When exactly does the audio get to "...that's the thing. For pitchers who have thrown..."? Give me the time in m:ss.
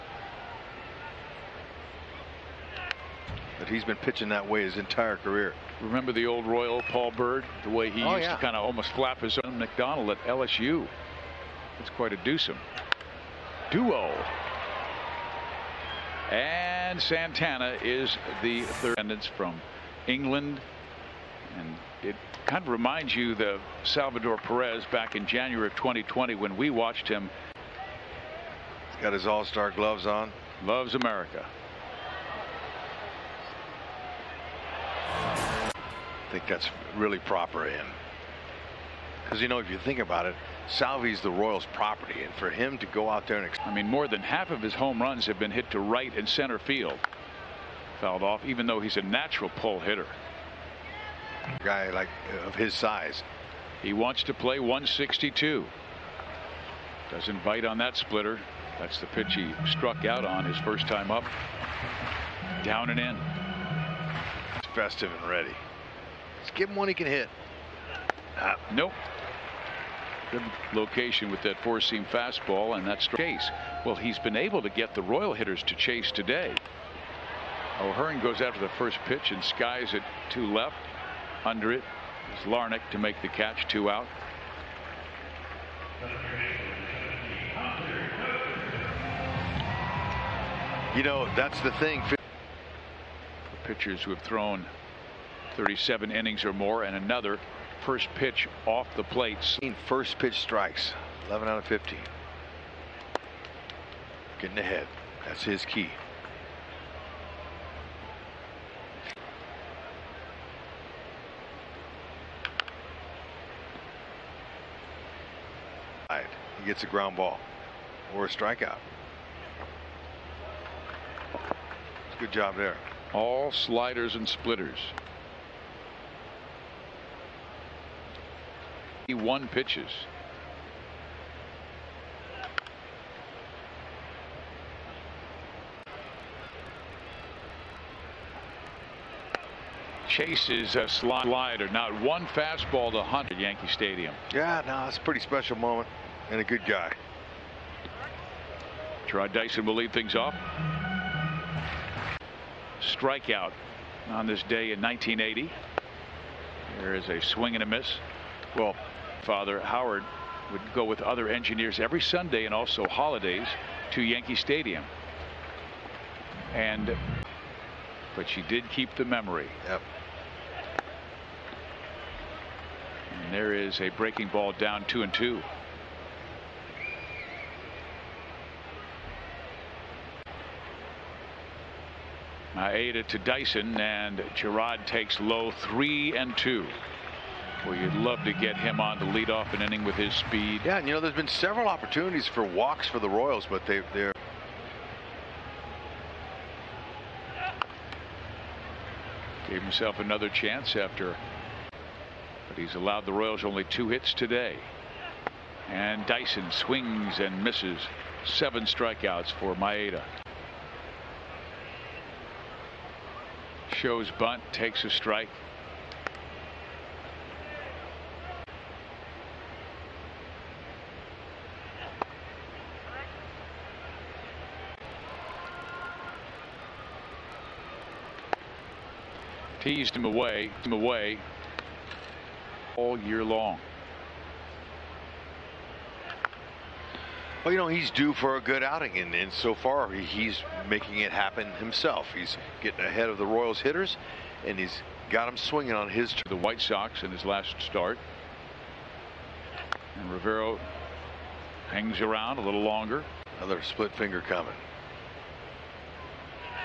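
1:31.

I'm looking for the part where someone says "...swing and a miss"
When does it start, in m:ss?
2:37.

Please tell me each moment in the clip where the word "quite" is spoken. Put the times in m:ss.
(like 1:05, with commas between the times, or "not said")
0:11.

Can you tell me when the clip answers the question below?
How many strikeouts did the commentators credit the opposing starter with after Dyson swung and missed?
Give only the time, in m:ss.
3:28.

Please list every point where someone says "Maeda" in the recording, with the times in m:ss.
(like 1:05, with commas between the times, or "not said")
3:02, 3:29.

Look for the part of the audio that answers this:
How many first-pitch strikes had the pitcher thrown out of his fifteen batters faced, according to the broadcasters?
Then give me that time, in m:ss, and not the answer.
1:41.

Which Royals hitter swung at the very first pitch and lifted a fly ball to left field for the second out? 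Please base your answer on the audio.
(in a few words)
O'Hearn.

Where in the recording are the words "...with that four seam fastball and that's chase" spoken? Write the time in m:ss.
1:11.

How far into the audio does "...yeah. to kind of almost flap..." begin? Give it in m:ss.
0:08.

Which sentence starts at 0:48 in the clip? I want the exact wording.
Fouled off, even though he's a natural pull hitter guy like of his size.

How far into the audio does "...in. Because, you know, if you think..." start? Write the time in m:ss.
0:37.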